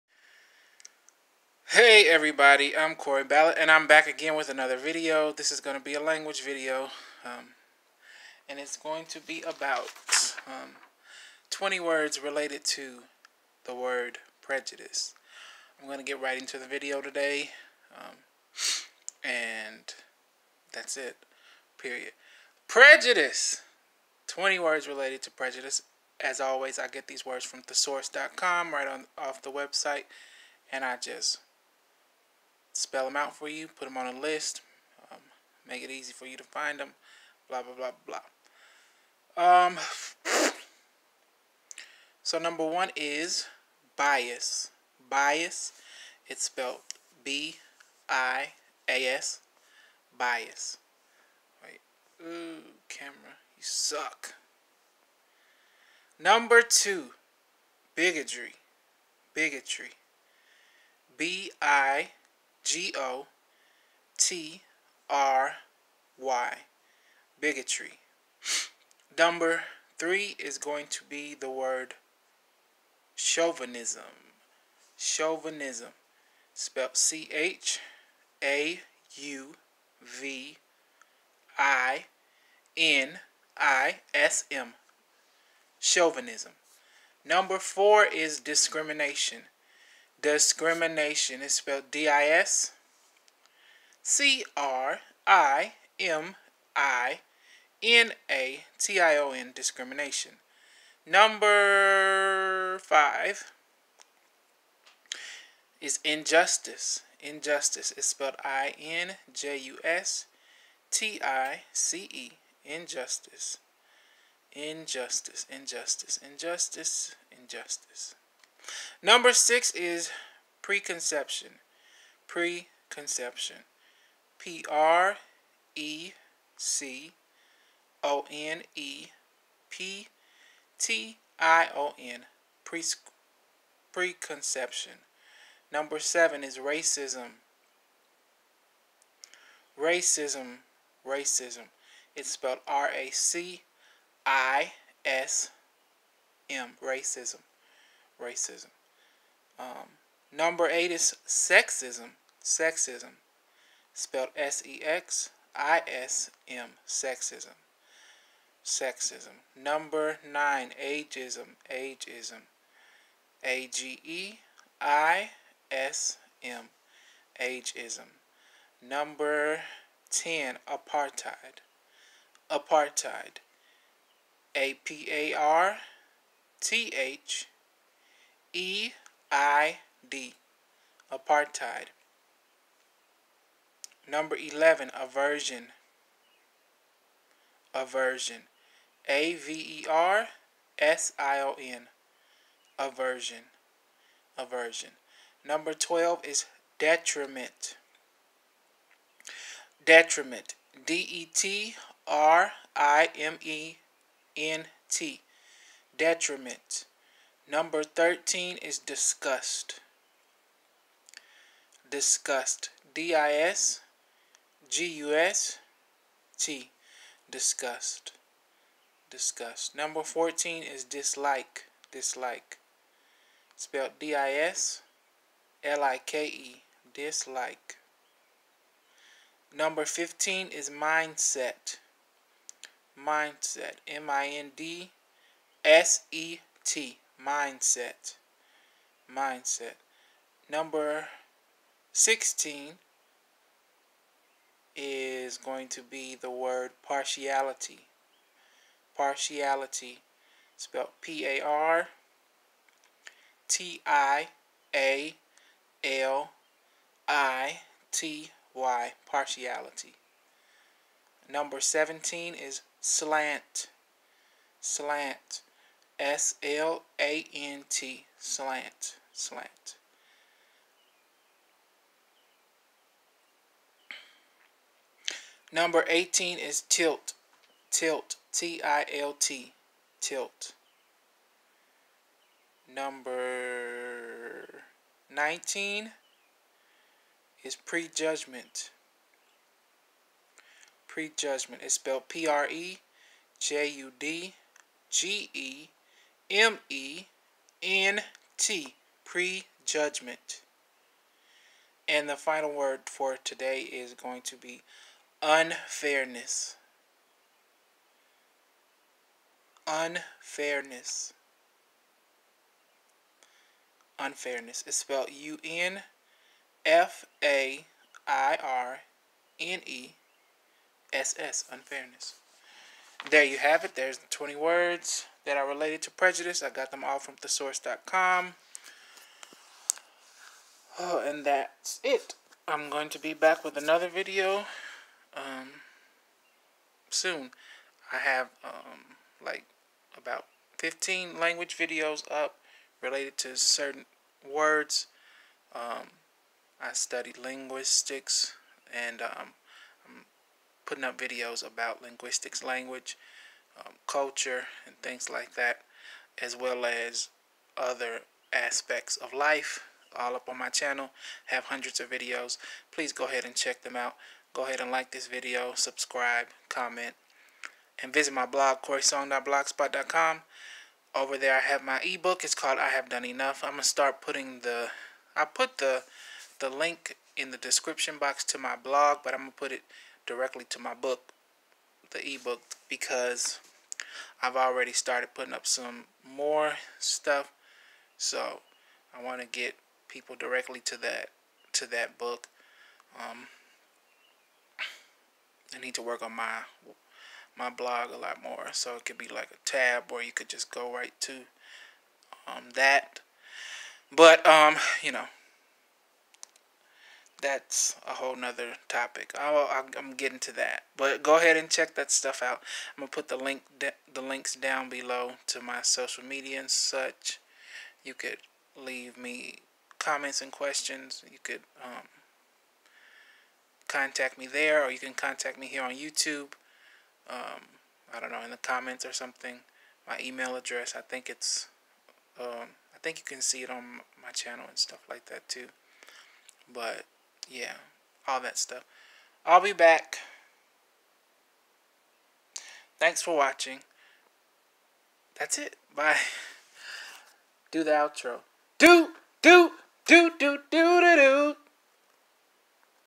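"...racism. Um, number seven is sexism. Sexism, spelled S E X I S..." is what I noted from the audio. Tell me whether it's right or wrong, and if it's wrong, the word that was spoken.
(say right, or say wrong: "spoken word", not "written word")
wrong: "eight", not "seven".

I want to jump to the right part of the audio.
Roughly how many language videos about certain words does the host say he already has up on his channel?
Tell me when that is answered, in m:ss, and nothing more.
5:39.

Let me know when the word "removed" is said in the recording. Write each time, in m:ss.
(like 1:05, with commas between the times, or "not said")
not said.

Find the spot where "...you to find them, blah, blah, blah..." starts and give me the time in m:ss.
0:36.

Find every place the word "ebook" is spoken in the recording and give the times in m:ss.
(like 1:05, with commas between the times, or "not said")
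6:11, 6:22.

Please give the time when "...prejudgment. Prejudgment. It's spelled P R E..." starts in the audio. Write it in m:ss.
4:47.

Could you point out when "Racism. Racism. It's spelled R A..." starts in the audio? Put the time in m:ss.
2:19.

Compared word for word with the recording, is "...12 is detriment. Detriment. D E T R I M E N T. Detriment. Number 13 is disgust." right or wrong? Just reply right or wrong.
right.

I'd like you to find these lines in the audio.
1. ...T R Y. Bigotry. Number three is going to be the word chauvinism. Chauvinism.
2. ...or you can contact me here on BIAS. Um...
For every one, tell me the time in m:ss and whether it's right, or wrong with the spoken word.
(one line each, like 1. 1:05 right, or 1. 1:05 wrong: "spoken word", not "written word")
1. 1:04 right
2. 7:04 wrong: "YouTube", not "BIAS".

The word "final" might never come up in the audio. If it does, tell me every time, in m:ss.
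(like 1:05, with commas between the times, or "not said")
5:02.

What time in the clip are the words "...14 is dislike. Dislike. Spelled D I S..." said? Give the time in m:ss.
3:40.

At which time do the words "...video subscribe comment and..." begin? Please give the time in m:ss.
6:05.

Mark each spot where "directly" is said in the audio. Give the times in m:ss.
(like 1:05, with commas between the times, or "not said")
6:20, 6:30.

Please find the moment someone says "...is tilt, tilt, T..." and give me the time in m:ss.
4:36.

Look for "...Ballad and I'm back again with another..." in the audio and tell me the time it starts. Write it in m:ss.
0:03.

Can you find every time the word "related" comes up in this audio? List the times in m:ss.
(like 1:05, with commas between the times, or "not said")
0:12, 0:24, 5:25, 5:42.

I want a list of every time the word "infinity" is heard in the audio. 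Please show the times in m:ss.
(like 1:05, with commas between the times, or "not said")
not said.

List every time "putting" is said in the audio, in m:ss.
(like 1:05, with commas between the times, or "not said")
5:50, 6:14, 6:25.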